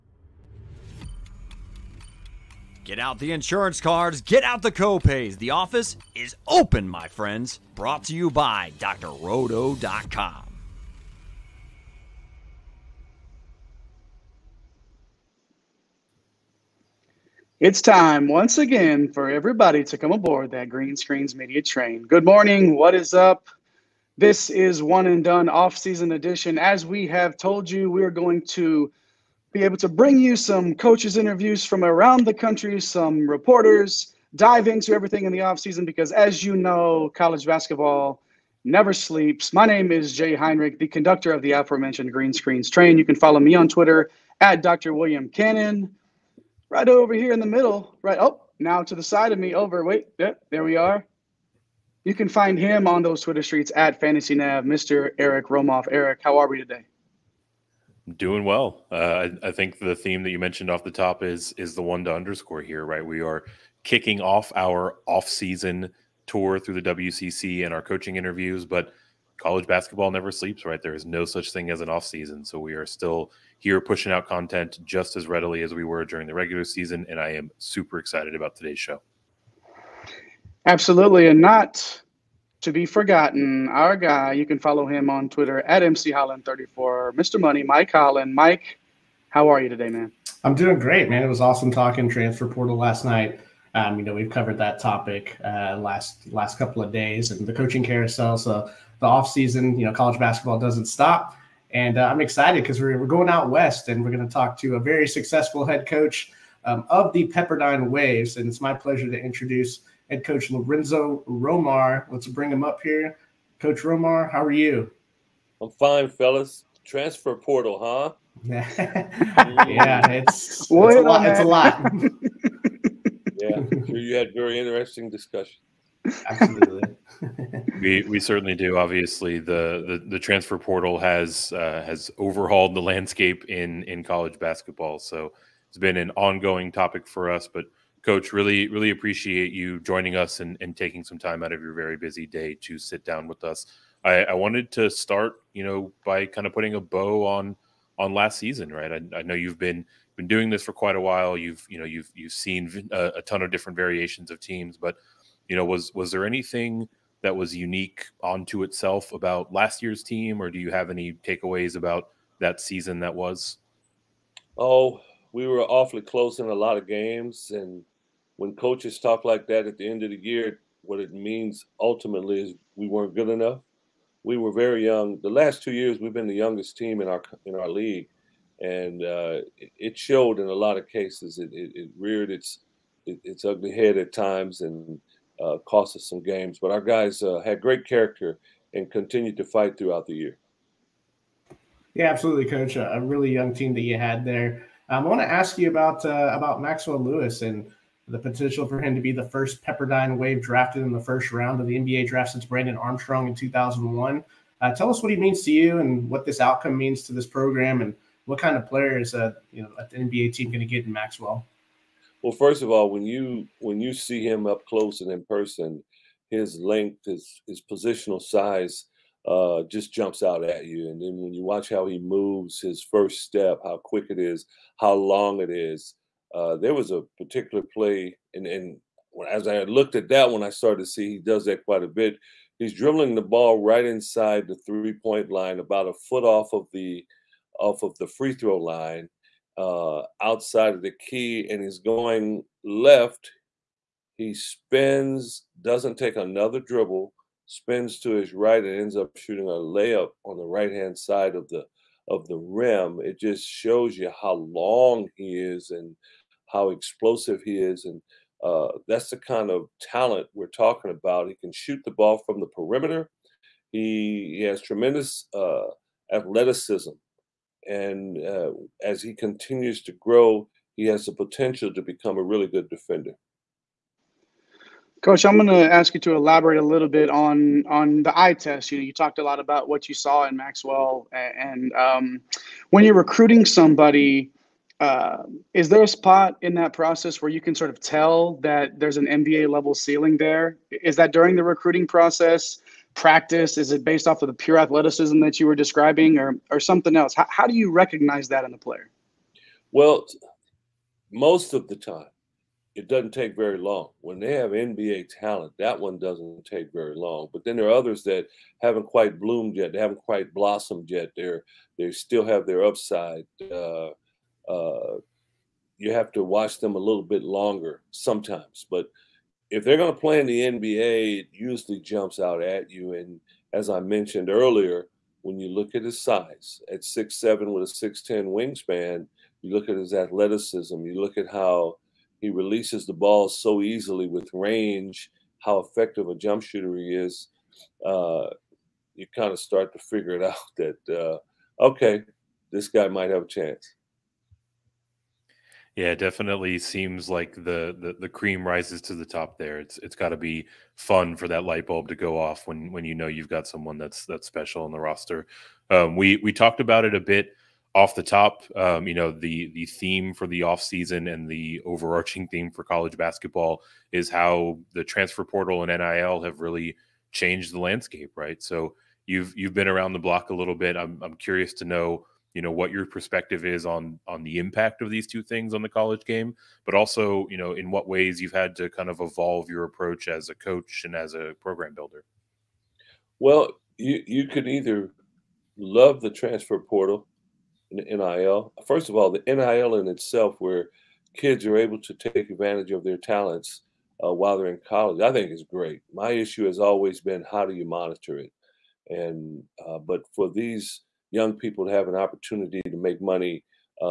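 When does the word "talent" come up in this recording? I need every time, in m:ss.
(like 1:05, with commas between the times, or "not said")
4:19, 5:05, 6:32.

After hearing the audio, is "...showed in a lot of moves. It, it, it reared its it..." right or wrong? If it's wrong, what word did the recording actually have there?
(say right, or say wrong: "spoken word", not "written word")
wrong: "cases", not "moves".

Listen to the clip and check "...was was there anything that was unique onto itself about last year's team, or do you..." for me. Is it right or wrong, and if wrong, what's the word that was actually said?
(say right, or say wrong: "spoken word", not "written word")
right.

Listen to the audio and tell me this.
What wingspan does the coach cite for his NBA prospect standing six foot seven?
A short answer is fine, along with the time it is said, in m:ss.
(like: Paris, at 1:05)
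6'10, at 5:27.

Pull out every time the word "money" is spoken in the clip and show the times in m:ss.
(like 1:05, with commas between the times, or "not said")
1:27, 6:42.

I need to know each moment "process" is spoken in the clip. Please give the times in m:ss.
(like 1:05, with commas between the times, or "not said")
4:46, 4:51.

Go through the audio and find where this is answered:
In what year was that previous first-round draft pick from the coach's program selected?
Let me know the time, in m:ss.
3:23.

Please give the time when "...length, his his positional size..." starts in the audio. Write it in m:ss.
3:36.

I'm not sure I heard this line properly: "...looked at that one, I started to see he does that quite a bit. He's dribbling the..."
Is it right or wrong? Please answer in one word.
right.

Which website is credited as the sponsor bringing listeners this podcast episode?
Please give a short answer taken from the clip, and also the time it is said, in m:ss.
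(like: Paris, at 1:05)
drrodo.com, at 0:08.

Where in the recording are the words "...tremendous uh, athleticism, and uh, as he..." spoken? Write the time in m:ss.
4:24.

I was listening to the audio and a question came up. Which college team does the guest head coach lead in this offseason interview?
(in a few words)
Pepperdine Waves.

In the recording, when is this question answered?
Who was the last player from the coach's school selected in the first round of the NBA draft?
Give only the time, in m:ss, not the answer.
3:22.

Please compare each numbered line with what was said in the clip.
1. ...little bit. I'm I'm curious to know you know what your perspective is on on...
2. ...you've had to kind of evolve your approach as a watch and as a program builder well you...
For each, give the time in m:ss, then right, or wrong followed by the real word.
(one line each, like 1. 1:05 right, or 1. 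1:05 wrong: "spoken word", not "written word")
1. 6:10 right
2. 6:18 wrong: "coach", not "watch".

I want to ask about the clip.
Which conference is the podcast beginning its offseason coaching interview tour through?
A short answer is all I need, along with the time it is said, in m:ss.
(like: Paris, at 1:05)
WCC, at 1:06.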